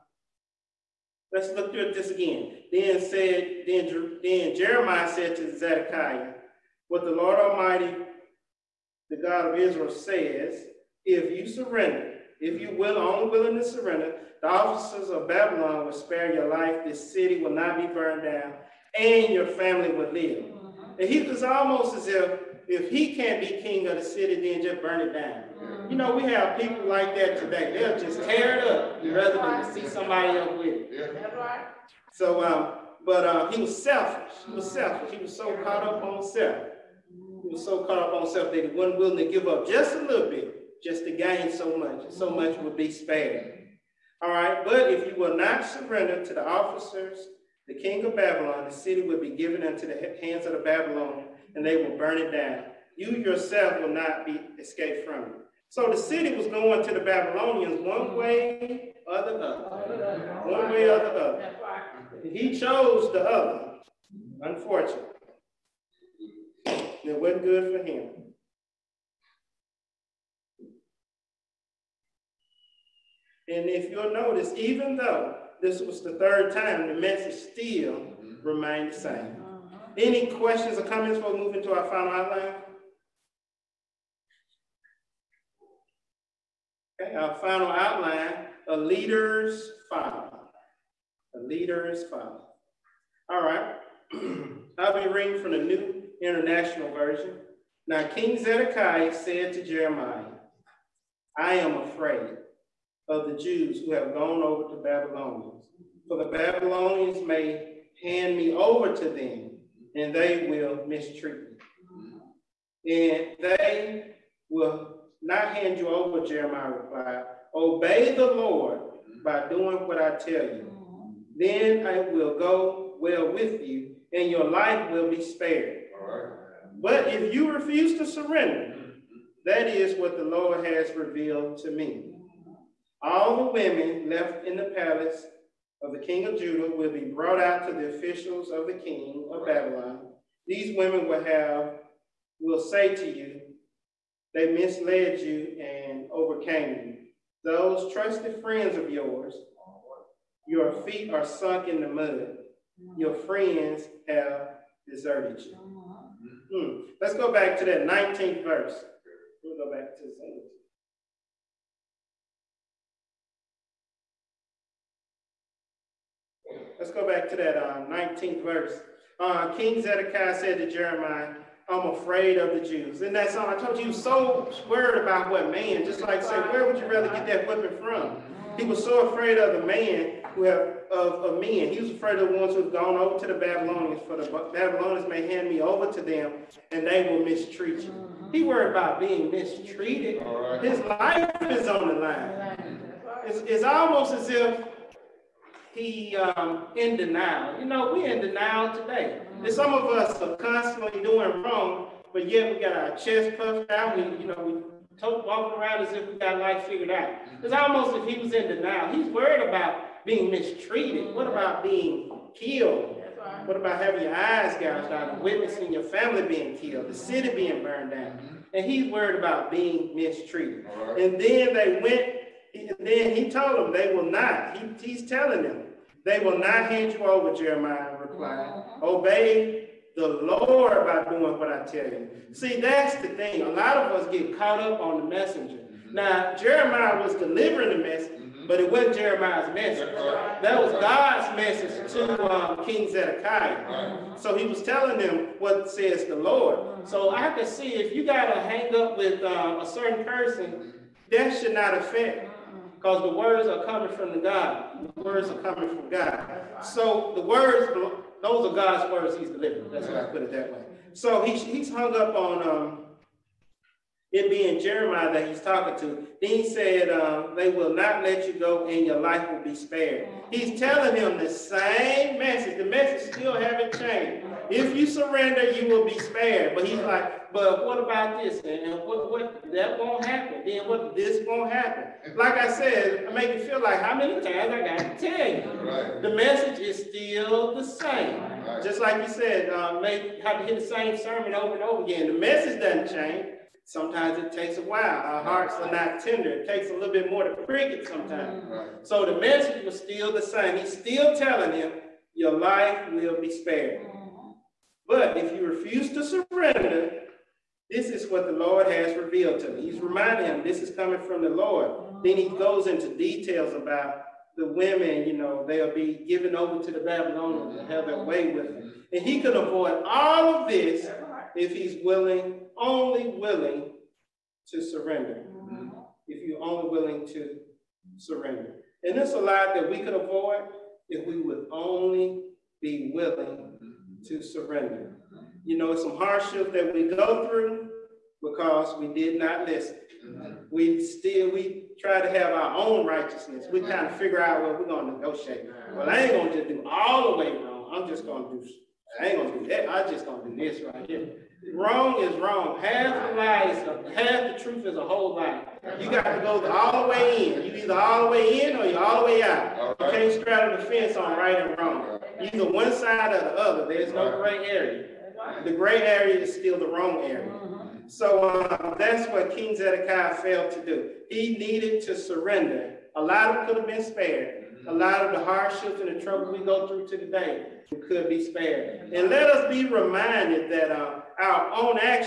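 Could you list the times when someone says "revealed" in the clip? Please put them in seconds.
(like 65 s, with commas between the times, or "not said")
130 s, 308 s.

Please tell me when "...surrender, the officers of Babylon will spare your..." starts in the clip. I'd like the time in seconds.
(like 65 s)
13 s.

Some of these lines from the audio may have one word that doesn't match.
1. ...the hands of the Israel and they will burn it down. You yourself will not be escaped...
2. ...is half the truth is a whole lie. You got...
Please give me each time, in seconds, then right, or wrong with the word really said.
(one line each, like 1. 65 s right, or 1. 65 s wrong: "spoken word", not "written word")
1. 49 s wrong: "Babylonians", not "Israel"
2. 353 s right.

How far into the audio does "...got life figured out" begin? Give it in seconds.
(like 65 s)
206 s.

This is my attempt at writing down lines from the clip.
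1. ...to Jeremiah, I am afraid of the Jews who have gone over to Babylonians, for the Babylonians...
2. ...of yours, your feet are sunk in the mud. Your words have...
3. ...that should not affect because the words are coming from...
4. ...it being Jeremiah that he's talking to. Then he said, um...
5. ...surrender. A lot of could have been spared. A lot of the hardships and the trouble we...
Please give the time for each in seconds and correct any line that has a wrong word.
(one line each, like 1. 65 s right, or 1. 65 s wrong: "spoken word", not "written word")
1. 99 s right
2. 148 s wrong: "friends", not "words"
3. 251 s right
4. 264 s right
5. 371 s right.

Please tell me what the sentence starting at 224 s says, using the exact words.
He, he's telling them they will not hand you over, Jeremiah replied.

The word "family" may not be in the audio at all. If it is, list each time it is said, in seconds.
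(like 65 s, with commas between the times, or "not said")
19 s, 215 s.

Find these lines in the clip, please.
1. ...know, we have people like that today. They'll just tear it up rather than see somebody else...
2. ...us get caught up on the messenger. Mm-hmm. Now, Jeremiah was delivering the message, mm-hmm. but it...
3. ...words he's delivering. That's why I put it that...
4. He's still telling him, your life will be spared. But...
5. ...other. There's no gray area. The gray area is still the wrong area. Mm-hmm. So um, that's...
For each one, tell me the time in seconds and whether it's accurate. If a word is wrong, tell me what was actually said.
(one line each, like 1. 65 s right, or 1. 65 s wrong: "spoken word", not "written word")
1. 25 s right
2. 233 s right
3. 258 s right
4. 300 s right
5. 363 s right.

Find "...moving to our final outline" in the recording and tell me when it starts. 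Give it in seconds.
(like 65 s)
81 s.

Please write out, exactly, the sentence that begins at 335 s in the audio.
You know, some hardships that we go through because we did not listen.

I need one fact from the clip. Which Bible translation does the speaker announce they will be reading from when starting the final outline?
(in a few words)
New International Version.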